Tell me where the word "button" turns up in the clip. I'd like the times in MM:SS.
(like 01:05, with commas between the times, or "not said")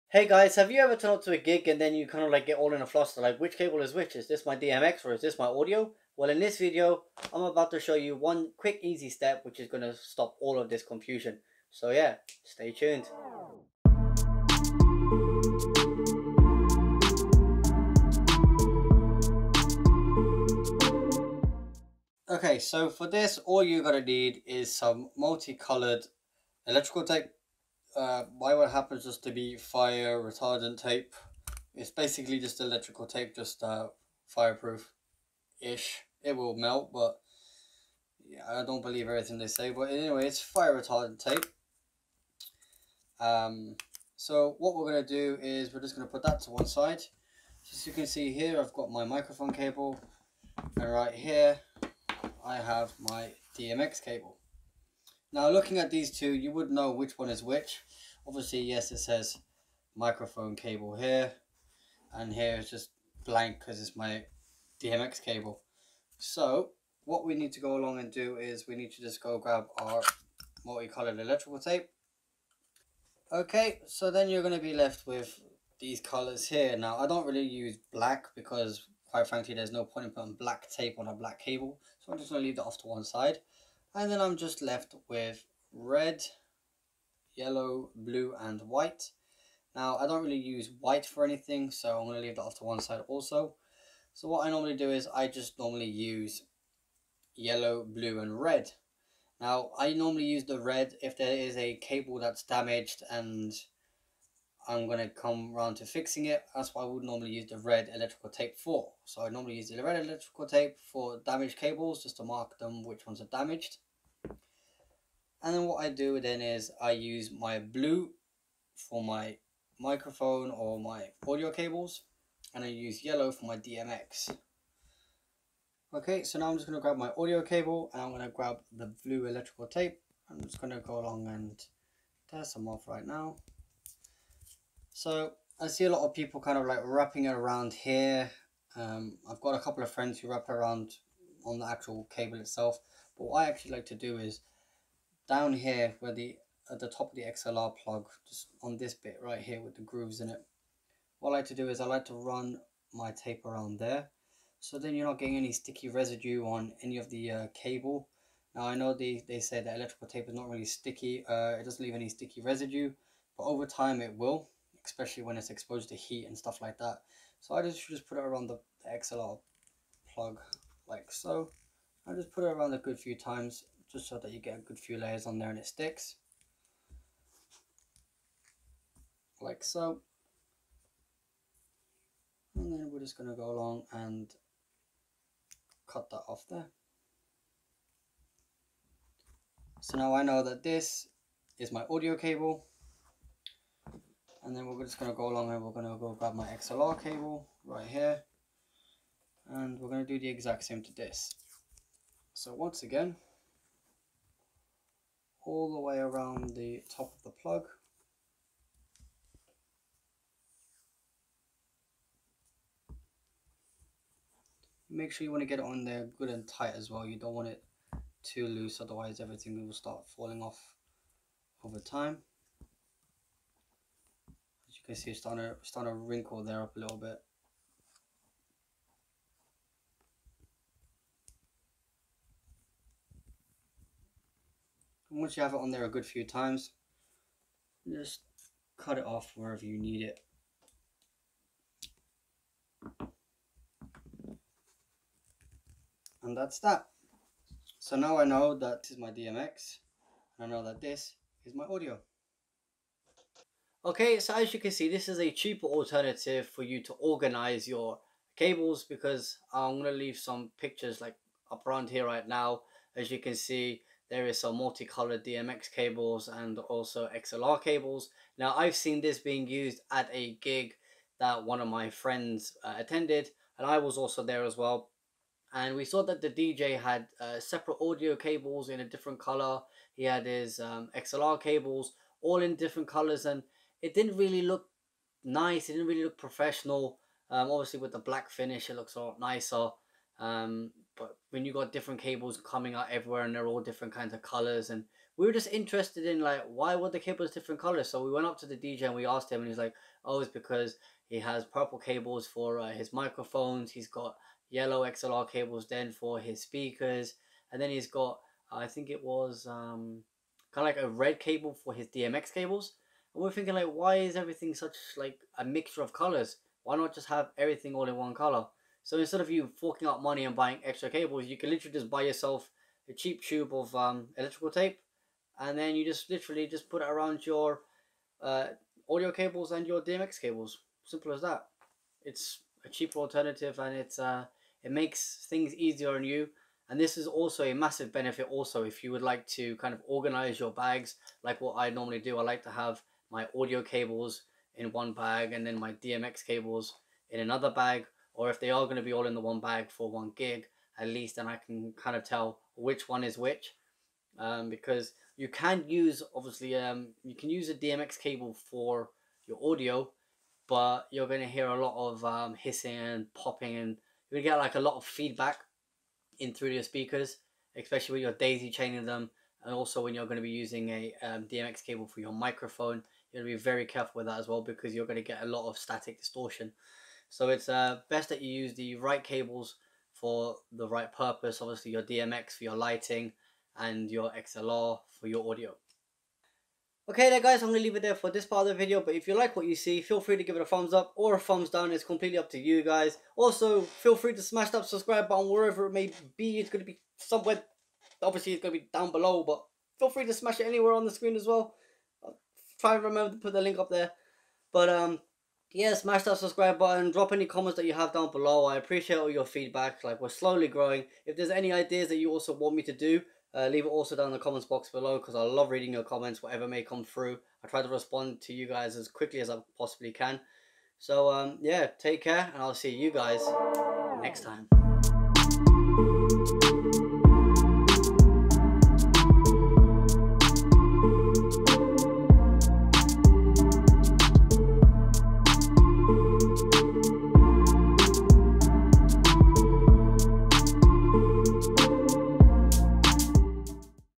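06:35, 06:46.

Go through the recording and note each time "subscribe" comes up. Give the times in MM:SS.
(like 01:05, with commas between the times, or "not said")
06:34, 06:46.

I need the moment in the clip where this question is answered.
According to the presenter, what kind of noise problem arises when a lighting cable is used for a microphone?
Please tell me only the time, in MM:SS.
06:14.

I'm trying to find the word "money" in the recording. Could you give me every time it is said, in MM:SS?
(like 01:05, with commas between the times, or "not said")
05:20.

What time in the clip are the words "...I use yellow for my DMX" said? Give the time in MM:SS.
02:02.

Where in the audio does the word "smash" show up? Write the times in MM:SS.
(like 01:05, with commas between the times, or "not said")
06:34, 06:40, 06:45.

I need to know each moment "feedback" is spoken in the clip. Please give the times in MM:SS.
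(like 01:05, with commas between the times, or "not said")
06:04, 06:49.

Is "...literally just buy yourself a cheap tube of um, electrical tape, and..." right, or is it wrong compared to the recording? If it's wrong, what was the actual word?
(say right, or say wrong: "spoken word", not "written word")
right.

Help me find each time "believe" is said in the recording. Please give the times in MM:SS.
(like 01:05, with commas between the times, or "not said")
00:38.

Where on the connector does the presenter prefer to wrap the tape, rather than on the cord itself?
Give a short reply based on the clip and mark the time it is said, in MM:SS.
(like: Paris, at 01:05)
Top of the XLR plug, at 02:26.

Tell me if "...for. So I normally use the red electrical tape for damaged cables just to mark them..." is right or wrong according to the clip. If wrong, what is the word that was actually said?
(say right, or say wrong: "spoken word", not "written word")
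right.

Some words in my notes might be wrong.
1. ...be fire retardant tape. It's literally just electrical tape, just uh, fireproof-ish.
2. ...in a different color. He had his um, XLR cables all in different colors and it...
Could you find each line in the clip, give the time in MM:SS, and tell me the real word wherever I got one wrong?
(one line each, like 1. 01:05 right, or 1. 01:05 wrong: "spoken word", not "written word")
1. 00:29 wrong: "basically", not "literally"
2. 04:38 right.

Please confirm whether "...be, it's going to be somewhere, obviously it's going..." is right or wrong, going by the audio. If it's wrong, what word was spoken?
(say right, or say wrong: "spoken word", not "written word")
right.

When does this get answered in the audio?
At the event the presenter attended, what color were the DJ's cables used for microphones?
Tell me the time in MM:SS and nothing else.
05:01.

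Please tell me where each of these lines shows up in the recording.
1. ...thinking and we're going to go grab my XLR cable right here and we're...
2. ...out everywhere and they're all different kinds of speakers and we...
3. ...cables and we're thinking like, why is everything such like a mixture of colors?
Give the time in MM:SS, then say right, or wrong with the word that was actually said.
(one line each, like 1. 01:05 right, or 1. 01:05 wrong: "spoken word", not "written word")
1. 03:15 wrong: "along", not "thinking"
2. 04:52 wrong: "colors", not "speakers"
3. 05:12 right.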